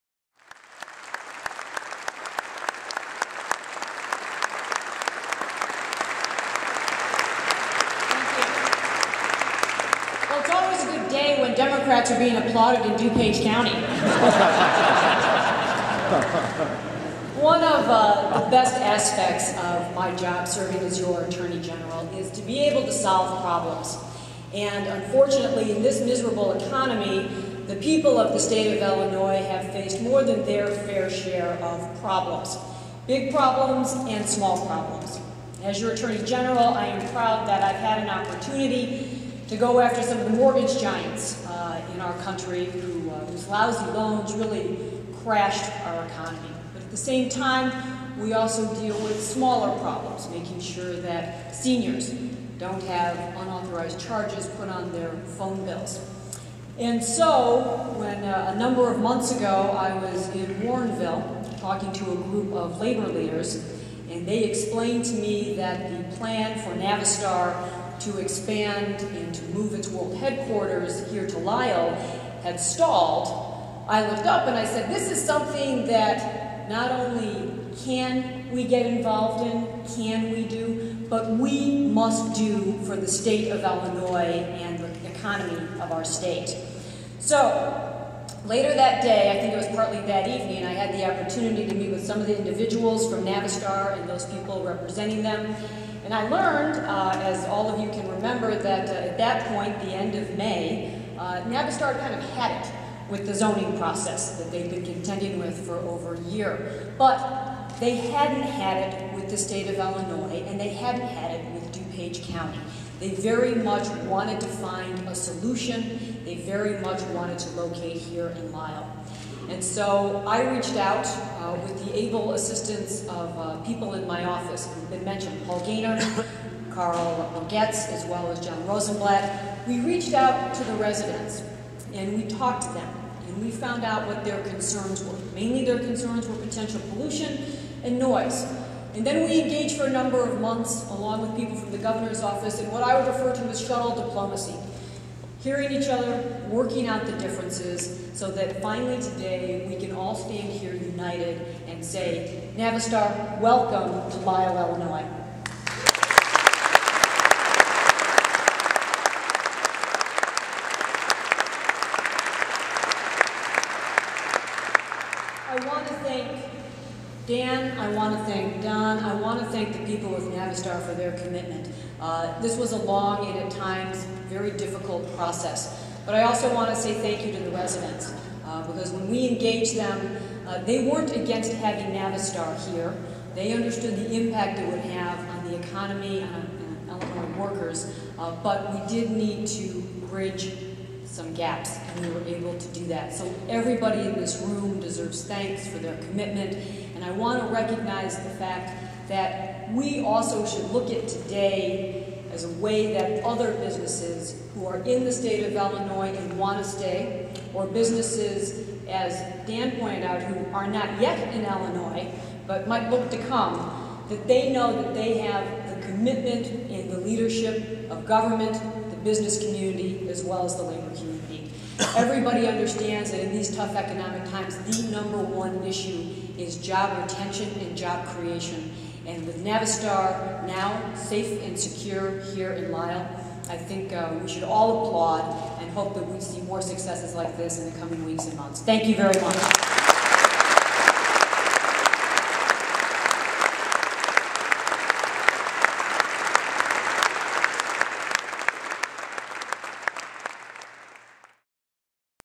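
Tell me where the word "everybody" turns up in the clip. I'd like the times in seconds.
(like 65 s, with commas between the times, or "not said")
193 s, 221 s.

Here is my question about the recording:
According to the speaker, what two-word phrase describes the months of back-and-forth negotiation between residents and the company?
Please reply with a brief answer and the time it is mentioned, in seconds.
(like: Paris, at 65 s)
Shuttle diplomacy, at 143 s.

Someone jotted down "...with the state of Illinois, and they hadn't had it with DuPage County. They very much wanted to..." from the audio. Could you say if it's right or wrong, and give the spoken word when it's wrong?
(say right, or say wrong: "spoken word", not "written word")
right.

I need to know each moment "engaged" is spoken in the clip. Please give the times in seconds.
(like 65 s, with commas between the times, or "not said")
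139 s, 179 s.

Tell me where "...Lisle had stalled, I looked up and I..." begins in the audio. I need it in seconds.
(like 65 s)
71 s.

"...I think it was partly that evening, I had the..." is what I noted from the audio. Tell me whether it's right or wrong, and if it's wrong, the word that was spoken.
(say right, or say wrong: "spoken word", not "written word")
right.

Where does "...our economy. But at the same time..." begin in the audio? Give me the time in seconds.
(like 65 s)
45 s.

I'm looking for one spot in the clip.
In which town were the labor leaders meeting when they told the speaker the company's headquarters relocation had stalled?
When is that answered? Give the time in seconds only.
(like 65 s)
60 s.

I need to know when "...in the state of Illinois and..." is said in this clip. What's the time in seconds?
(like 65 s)
204 s.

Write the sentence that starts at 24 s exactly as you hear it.
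And unfortunately, in this miserable economy, the people of the state of Illinois have faced more than their fair share of problems.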